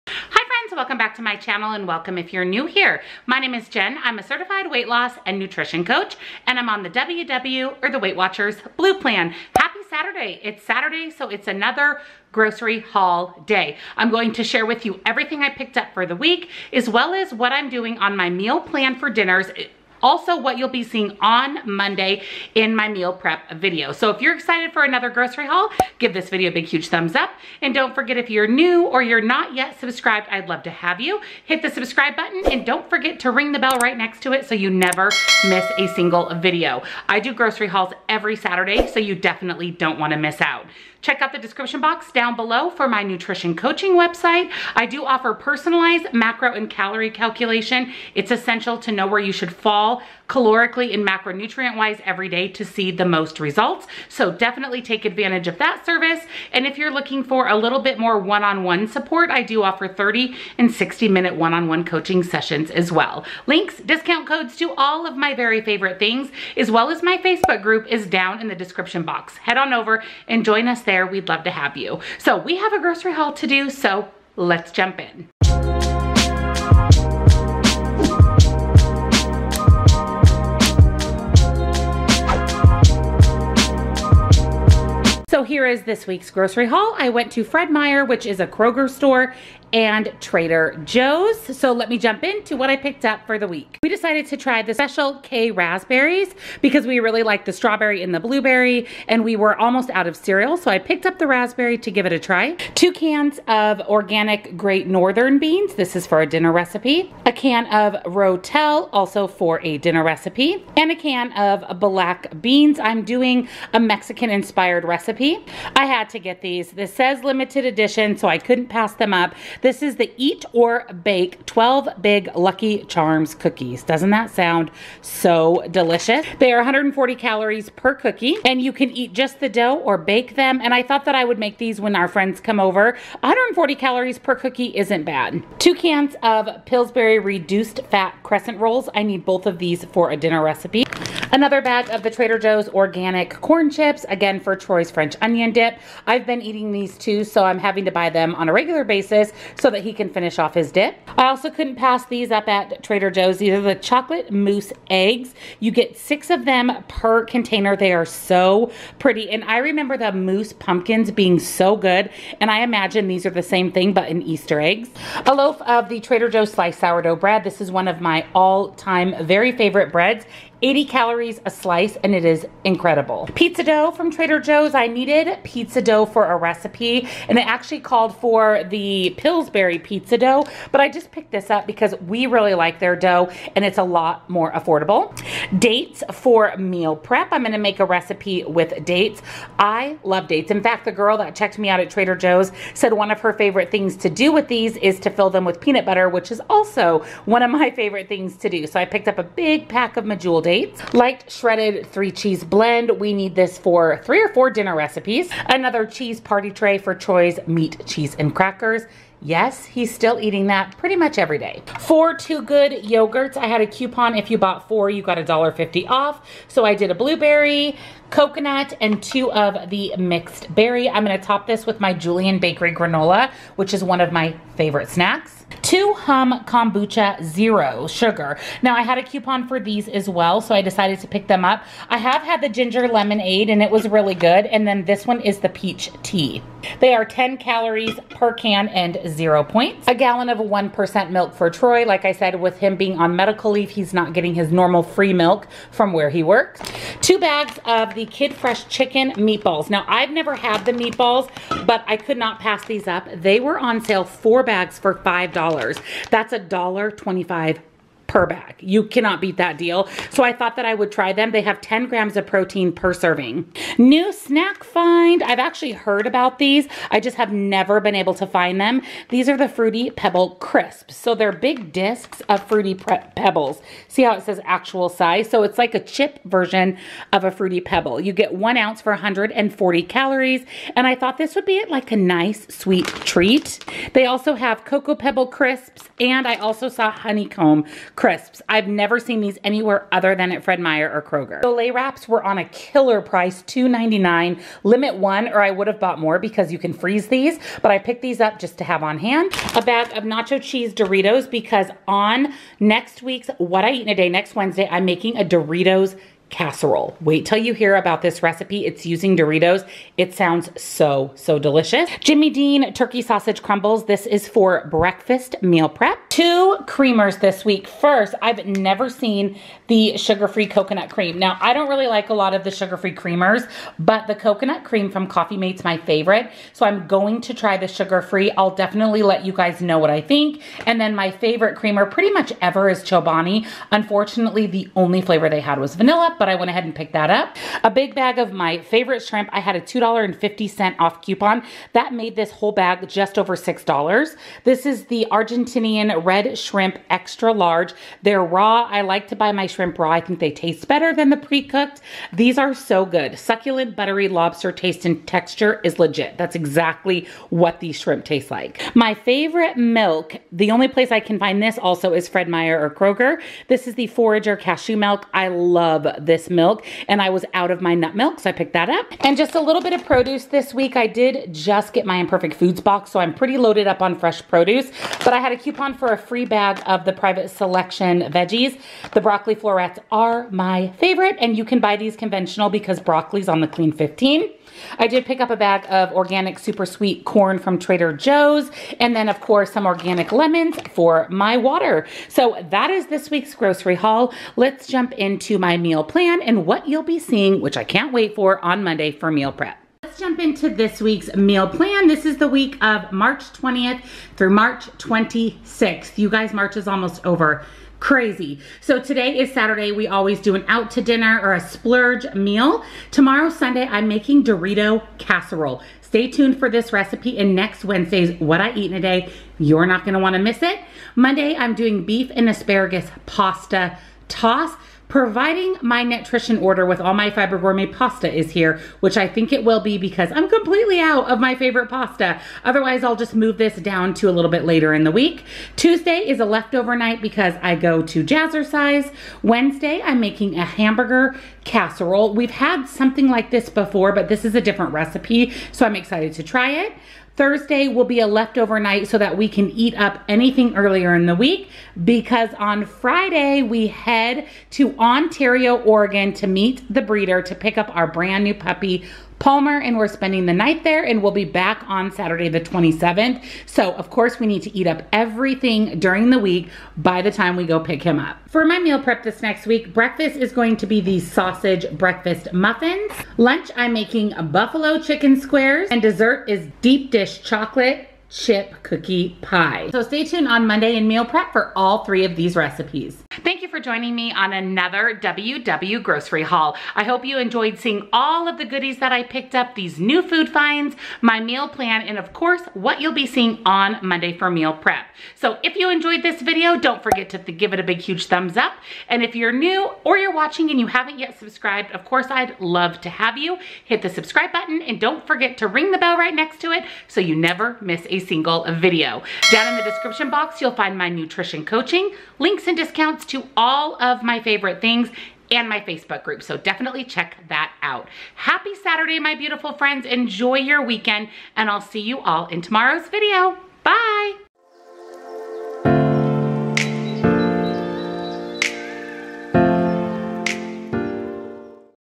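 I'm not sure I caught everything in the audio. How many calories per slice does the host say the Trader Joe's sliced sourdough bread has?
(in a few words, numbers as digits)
80.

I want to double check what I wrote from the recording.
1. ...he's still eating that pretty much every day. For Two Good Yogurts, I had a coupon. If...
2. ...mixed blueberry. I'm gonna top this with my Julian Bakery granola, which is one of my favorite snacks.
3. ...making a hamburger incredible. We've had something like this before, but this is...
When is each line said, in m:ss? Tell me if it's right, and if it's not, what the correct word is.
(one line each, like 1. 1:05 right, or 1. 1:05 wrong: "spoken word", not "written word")
1. 3:29 right
2. 3:39 wrong: "berry", not "blueberry"
3. 7:20 wrong: "casserole", not "incredible".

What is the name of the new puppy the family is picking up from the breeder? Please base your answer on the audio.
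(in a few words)
Palmer.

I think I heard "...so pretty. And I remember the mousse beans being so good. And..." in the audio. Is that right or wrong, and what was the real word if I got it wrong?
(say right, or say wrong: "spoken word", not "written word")
wrong: "pumpkins", not "beans".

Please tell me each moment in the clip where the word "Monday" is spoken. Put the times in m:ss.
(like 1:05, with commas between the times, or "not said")
0:21, 6:38, 7:00, 8:00, 8:13.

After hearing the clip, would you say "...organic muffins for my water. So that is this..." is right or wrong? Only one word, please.
wrong.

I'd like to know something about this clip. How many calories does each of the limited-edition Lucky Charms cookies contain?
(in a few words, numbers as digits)
140.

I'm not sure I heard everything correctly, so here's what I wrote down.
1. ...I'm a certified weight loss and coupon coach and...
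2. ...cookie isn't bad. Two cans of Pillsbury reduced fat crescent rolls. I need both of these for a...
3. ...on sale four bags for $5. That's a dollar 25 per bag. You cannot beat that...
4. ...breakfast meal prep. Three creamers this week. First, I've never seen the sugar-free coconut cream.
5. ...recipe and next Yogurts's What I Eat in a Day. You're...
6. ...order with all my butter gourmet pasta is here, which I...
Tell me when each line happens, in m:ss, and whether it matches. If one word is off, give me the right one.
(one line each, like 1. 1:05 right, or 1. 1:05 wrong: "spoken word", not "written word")
1. 0:04 wrong: "nutrition", not "coupon"
2. 2:14 right
3. 4:13 right
4. 5:14 wrong: "Two", not "Three"
5. 6:56 wrong: "Wednesday", not "Yogurts"
6. 7:06 wrong: "fiber", not "butter".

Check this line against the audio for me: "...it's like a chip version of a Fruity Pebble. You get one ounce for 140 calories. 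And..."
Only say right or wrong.
right.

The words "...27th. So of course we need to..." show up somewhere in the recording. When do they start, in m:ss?
7:42.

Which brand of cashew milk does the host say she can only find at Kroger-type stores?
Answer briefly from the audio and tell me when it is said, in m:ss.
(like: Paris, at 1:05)
Forager, at 6:03.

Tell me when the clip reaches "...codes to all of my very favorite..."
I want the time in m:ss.
1:04.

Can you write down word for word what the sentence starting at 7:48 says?
For my meal prep this next week, breakfast is going to be the sausage breakfast muffins.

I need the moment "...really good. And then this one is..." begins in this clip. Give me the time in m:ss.
3:53.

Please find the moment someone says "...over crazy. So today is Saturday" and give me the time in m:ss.
6:47.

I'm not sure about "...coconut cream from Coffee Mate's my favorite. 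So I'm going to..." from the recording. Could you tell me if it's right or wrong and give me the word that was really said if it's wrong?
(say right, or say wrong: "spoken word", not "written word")
right.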